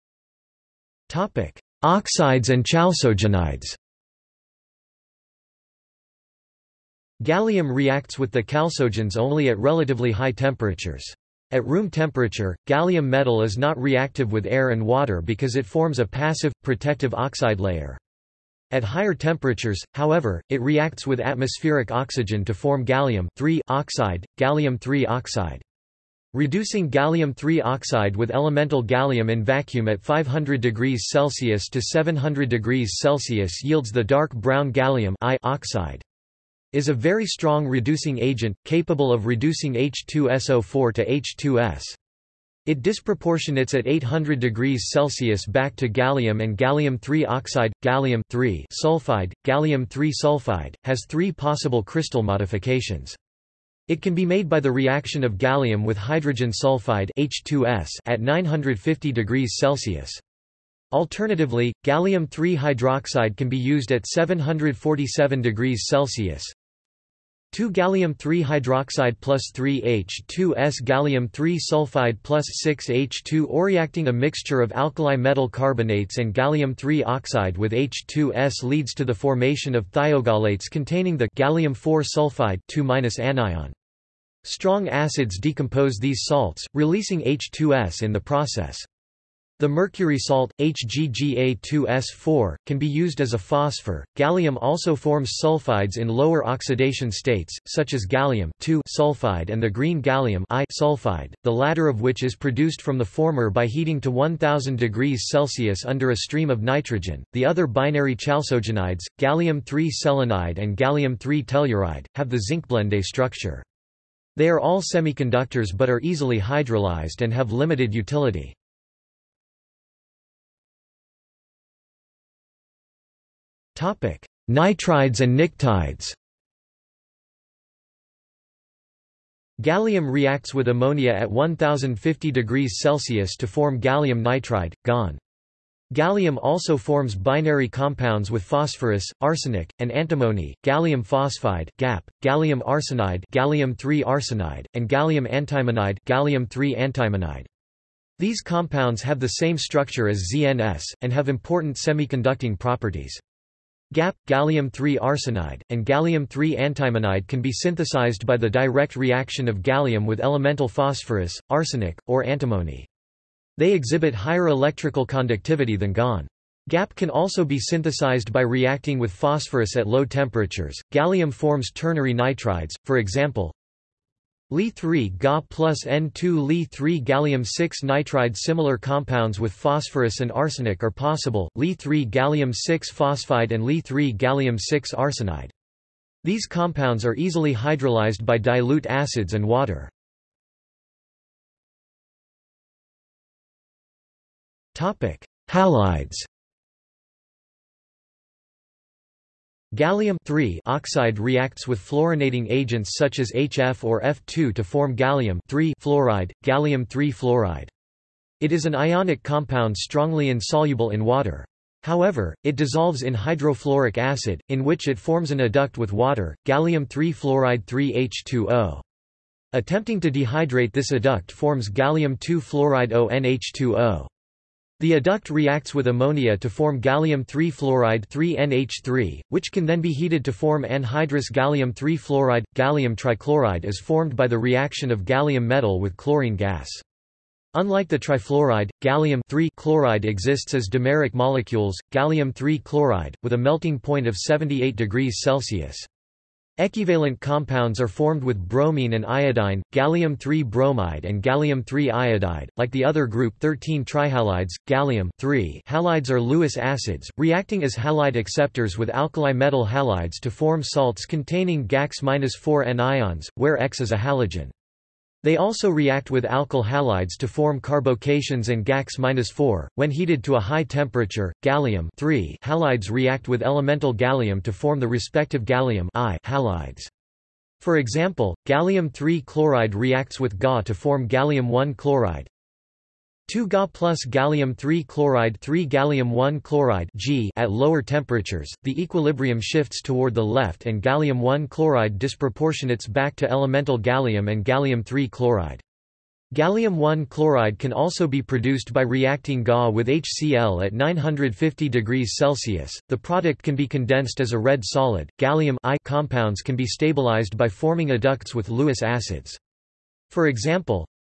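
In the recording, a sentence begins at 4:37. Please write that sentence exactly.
For example, gallium-3 chloride reacts with Ga to form gallium-1 chloride.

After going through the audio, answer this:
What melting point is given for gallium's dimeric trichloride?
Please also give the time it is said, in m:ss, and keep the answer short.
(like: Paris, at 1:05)
78 degrees Celsius, at 4:04.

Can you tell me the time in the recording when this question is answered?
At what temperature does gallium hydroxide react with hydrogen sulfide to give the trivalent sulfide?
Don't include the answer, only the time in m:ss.
1:04.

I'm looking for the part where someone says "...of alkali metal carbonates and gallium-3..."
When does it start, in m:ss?
1:14.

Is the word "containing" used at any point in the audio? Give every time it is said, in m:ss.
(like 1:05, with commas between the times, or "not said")
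1:20, 4:21.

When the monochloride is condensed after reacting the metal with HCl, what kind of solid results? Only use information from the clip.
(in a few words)
red solid.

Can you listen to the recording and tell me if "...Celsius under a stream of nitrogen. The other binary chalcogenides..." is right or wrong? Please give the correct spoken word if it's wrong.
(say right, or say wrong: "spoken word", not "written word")
right.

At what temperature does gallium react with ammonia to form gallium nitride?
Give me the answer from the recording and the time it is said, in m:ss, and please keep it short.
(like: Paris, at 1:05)
1050 degrees Celsius, at 2:11.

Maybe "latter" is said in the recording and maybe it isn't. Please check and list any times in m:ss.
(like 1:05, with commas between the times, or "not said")
1:41.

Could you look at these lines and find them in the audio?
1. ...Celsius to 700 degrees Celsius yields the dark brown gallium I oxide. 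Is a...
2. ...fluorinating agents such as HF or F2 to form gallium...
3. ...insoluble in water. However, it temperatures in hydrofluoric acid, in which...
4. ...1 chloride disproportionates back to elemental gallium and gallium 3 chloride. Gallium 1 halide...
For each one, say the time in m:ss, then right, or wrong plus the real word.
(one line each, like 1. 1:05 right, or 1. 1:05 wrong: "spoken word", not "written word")
1. 0:31 right
2. 3:21 right
3. 3:30 wrong: "dissolves", not "temperatures"
4. 4:51 wrong: "chloride", not "halide".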